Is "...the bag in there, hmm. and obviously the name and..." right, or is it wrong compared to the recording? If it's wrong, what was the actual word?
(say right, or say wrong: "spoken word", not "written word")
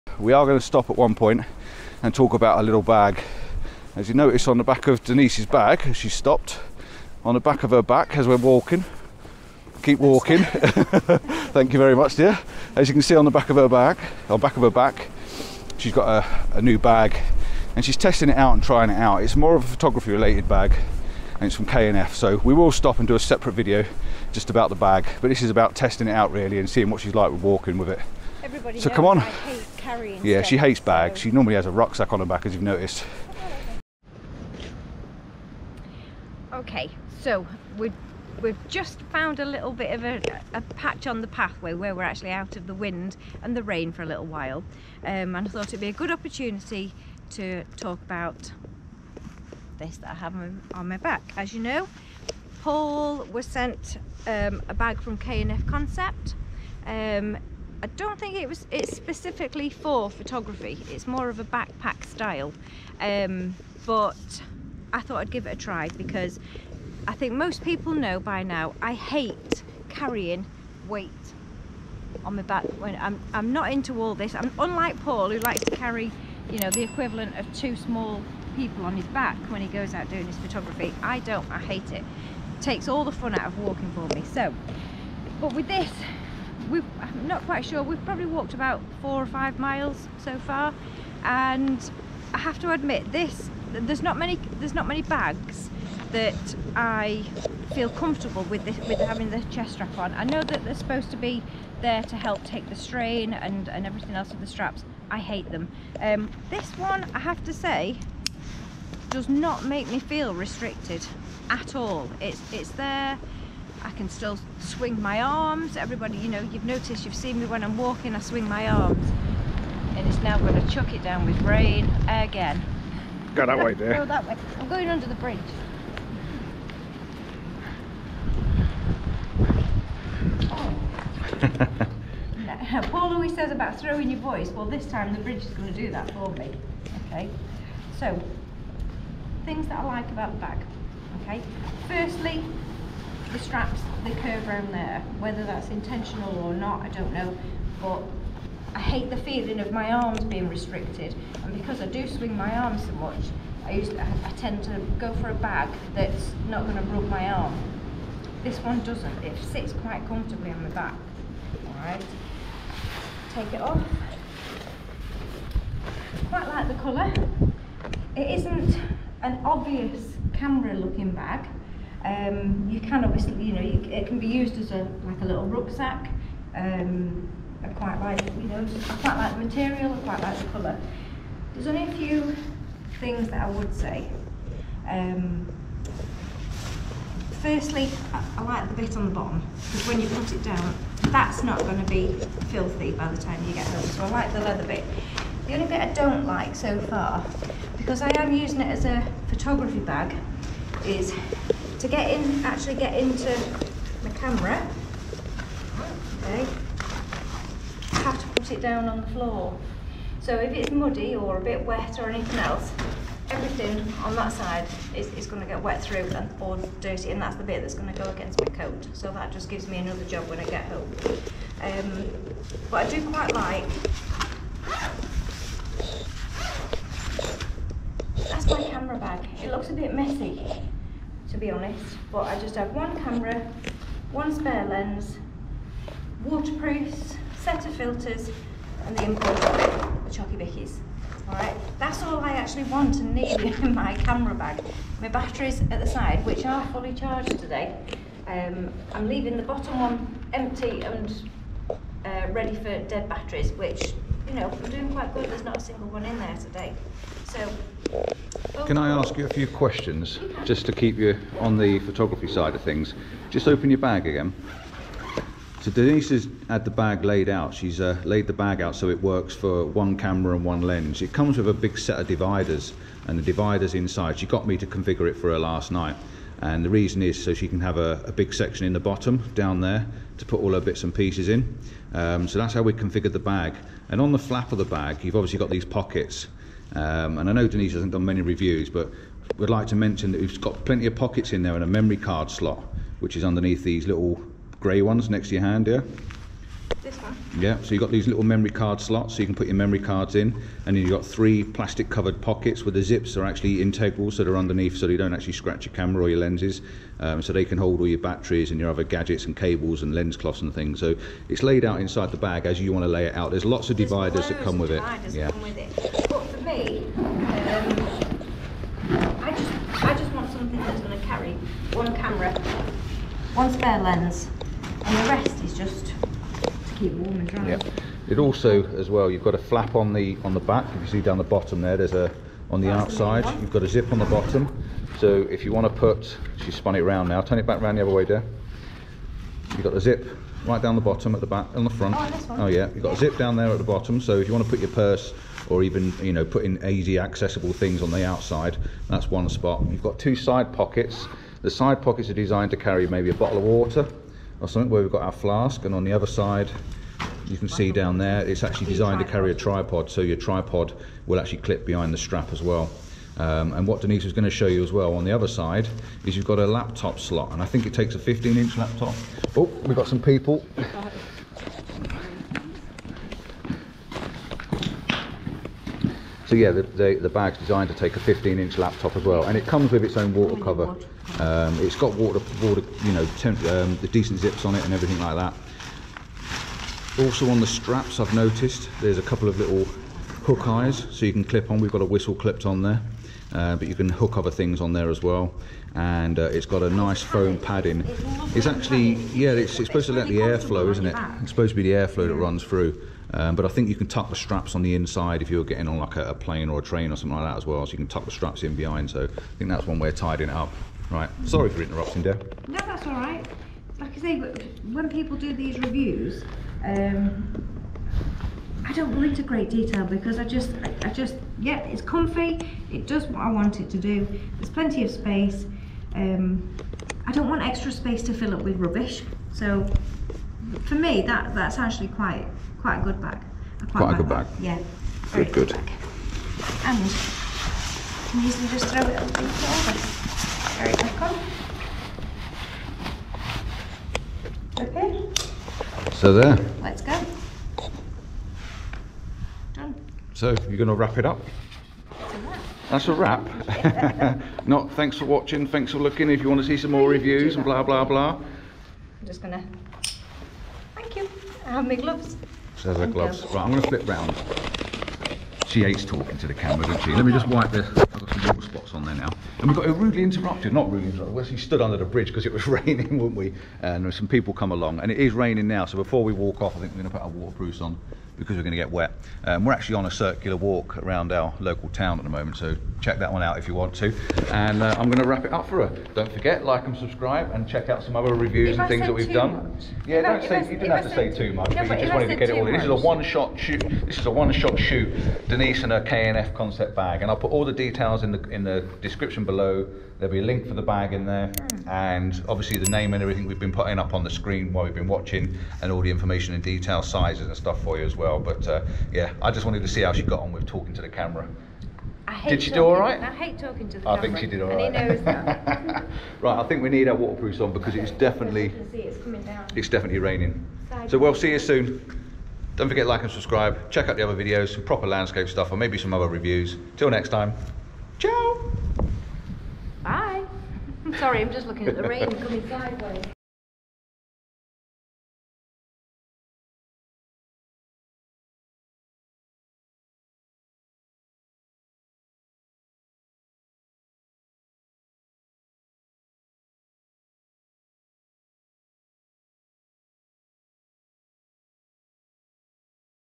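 right.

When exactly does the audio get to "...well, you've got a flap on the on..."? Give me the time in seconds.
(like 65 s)
328 s.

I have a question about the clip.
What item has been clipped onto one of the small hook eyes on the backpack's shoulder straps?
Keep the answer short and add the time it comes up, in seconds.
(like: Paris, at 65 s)
a whistle, at 391 s.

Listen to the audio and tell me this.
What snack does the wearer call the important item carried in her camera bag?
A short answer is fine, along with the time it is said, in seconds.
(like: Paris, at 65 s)
Chocky Bickies, at 239 s.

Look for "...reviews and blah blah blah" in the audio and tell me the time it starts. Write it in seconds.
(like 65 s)
456 s.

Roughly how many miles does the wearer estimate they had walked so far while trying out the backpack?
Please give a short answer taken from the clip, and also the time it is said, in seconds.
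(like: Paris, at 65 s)
four or five, at 89 s.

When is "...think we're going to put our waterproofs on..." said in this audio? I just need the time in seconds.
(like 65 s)
476 s.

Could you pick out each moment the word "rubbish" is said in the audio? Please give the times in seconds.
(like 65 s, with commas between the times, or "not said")
428 s.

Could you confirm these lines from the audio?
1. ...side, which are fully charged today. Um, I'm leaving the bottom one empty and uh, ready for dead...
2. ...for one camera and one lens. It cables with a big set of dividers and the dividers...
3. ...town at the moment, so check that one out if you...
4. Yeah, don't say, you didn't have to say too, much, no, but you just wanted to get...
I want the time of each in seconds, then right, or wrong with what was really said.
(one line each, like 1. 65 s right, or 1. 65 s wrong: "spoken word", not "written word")
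1. 245 s right
2. 269 s wrong: "comes", not "cables"
3. 481 s right
4. 489 s right.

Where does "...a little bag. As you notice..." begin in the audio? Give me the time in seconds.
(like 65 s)
2 s.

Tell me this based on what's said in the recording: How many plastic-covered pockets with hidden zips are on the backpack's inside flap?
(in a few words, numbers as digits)
3.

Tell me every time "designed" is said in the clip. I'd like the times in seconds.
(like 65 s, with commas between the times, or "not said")
352 s, 358 s, 377 s.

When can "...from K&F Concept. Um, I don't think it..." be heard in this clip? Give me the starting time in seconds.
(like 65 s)
55 s.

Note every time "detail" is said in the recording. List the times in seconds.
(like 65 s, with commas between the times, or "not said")
419 s, 497 s, 506 s.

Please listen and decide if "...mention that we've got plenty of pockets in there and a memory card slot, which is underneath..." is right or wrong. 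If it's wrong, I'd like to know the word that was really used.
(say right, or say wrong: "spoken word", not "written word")
right.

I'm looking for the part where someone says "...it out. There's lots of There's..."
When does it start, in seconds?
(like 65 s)
313 s.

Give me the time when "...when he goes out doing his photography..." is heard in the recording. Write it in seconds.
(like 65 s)
79 s.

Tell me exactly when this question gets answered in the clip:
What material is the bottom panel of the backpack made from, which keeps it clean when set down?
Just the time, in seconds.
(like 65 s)
194 s.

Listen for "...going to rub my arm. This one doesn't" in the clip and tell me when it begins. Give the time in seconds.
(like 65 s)
156 s.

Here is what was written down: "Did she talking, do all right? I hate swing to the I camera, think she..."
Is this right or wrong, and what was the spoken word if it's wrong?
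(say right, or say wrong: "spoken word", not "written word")
wrong: "talking", not "swing".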